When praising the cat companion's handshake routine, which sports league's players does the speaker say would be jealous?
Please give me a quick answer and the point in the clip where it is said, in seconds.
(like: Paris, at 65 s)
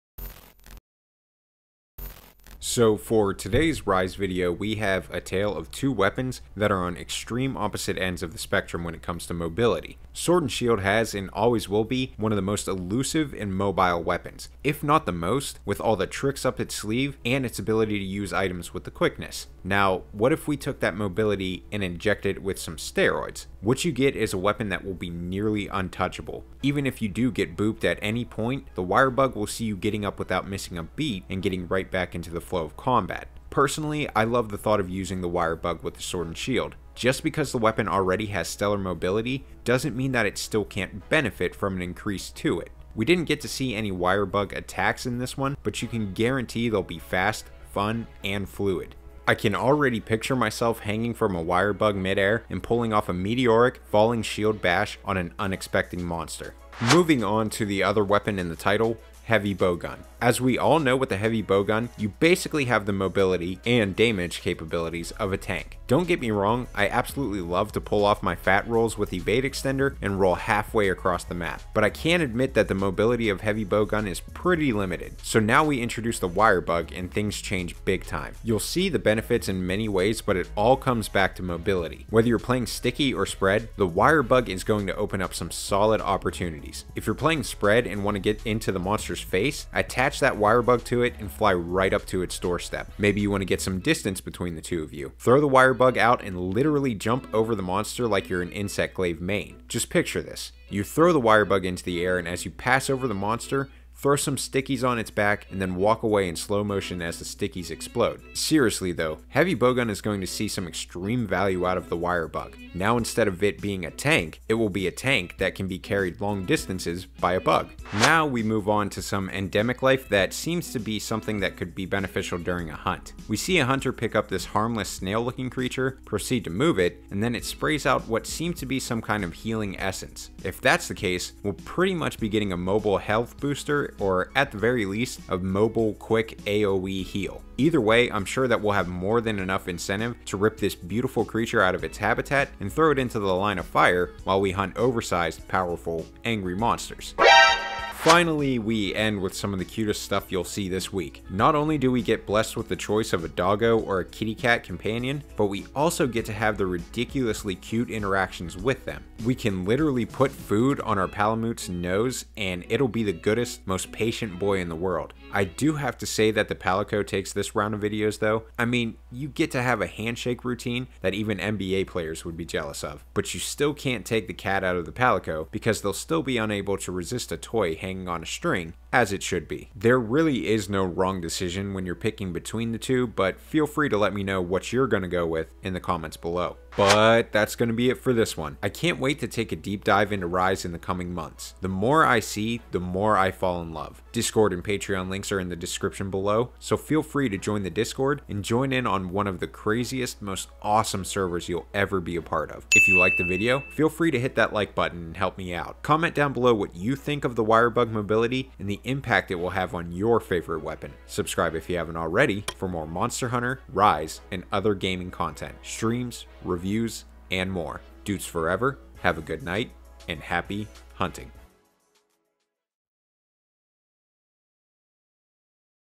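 NBA, at 171 s.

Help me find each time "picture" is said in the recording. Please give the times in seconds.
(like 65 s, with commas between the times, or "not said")
50 s, 99 s.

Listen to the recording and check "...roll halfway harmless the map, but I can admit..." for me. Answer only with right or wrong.
wrong.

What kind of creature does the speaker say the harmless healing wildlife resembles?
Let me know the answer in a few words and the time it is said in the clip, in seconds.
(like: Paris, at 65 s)
snail, at 124 s.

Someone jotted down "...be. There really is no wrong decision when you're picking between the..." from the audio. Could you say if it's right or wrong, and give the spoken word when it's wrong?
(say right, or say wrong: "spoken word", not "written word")
right.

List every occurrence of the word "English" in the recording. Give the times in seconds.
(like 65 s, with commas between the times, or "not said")
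not said.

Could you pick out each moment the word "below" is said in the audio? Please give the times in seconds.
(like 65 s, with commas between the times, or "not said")
186 s, 196 s, 206 s.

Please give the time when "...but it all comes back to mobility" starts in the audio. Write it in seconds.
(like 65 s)
80 s.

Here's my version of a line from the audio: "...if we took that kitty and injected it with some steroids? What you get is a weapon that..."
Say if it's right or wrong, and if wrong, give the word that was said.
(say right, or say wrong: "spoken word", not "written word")
wrong: "mobility", not "kitty".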